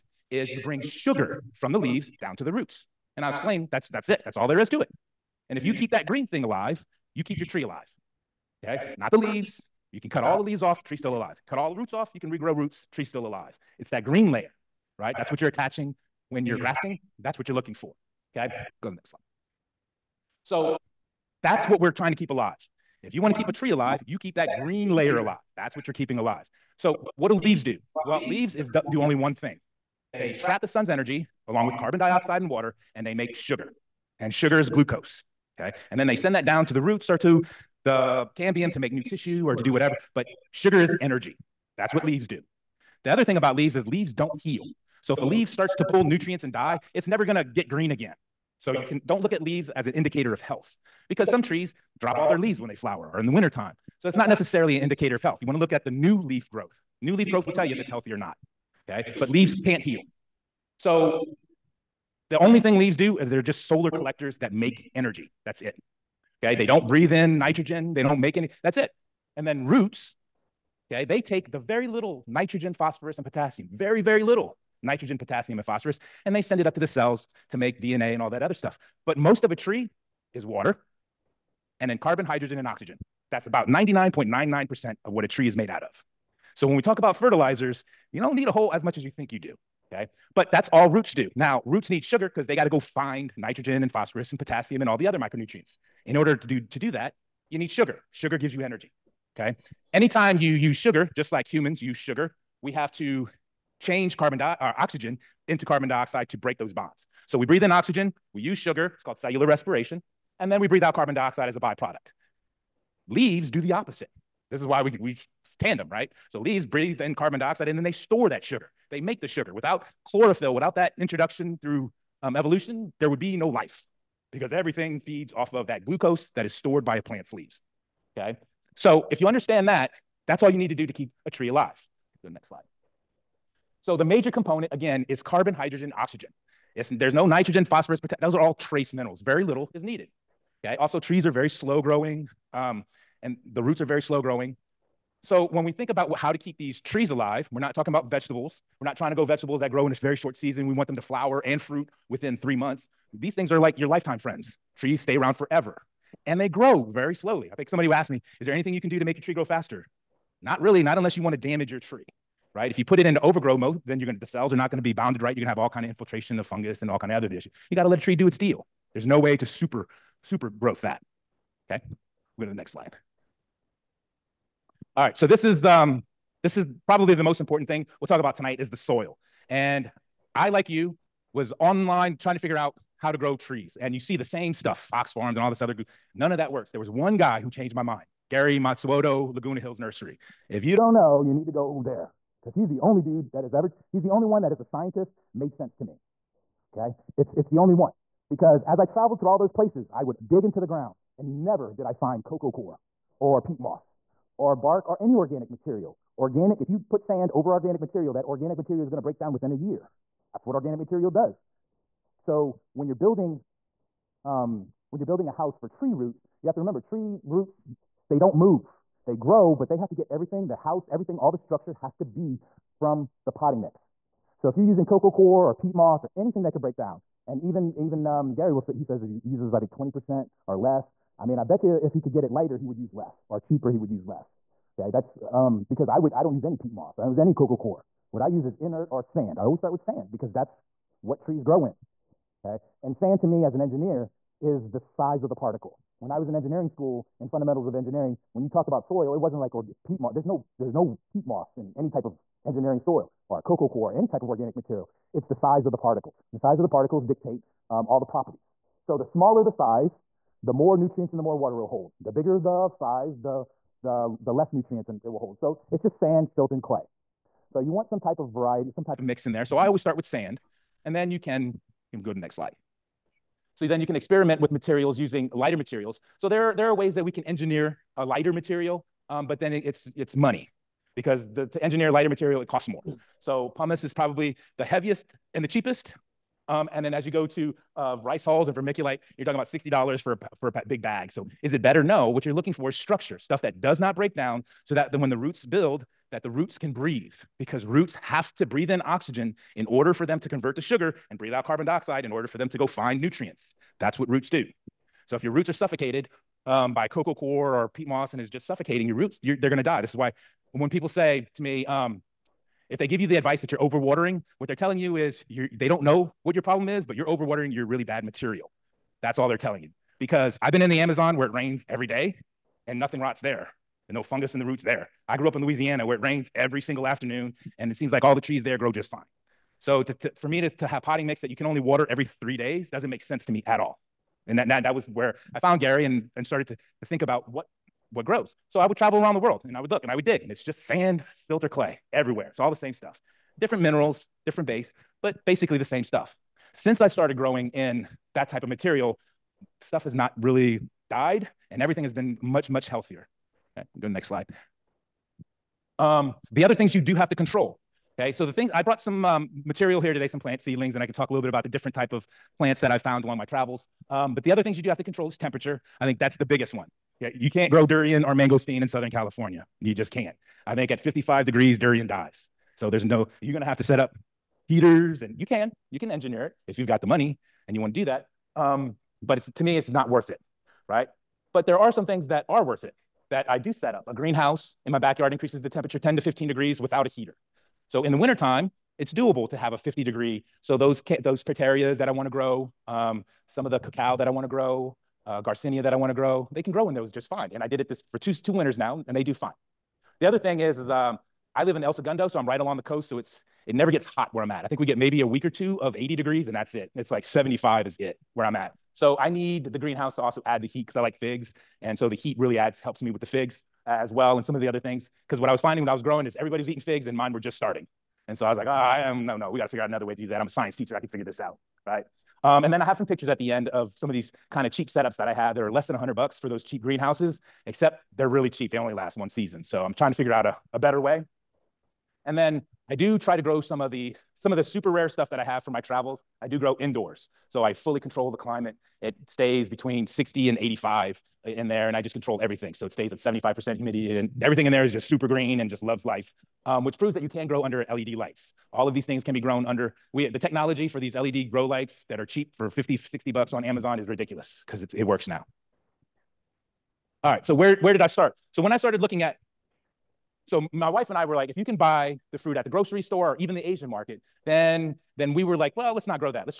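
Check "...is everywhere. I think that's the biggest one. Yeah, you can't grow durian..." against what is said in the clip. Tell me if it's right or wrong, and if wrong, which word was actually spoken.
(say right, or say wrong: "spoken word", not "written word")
wrong: "temperature", not "everywhere".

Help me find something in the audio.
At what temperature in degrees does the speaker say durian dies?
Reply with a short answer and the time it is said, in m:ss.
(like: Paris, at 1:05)
55 degrees, at 6:10.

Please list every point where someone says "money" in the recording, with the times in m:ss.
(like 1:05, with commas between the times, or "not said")
4:40, 6:16.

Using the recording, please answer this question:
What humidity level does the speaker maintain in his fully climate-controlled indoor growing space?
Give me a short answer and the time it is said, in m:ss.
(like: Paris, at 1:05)
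75%, at 7:22.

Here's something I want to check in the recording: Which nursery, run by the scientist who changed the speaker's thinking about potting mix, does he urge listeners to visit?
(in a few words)
Laguna Hills Nursery.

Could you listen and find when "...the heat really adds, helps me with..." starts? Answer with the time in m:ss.
6:51.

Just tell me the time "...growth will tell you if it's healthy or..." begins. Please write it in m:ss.
0:57.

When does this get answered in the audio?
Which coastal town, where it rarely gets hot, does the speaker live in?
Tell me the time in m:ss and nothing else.
6:41.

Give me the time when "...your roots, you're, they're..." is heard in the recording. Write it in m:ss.
5:08.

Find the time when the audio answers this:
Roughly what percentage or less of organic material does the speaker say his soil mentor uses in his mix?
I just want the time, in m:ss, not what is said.
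3:49.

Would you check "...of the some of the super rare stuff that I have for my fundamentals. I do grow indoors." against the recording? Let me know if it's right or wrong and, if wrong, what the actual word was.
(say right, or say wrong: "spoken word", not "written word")
wrong: "travels", not "fundamentals".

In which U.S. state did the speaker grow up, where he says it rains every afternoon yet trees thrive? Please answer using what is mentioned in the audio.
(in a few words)
Louisiana.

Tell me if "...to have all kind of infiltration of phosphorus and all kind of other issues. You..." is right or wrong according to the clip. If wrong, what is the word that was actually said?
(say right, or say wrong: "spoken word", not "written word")
wrong: "fungus", not "phosphorus".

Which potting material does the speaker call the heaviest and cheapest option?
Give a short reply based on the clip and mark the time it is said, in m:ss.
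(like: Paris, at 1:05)
pumice, at 4:43.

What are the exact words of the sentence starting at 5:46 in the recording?
Since I started growing in that type of material, stuff has not really died and everything has been much, much healthier.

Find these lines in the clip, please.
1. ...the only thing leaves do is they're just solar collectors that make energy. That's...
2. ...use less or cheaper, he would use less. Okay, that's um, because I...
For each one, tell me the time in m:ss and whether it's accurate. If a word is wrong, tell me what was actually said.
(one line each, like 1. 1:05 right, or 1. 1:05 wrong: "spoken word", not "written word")
1. 1:02 right
2. 3:52 right.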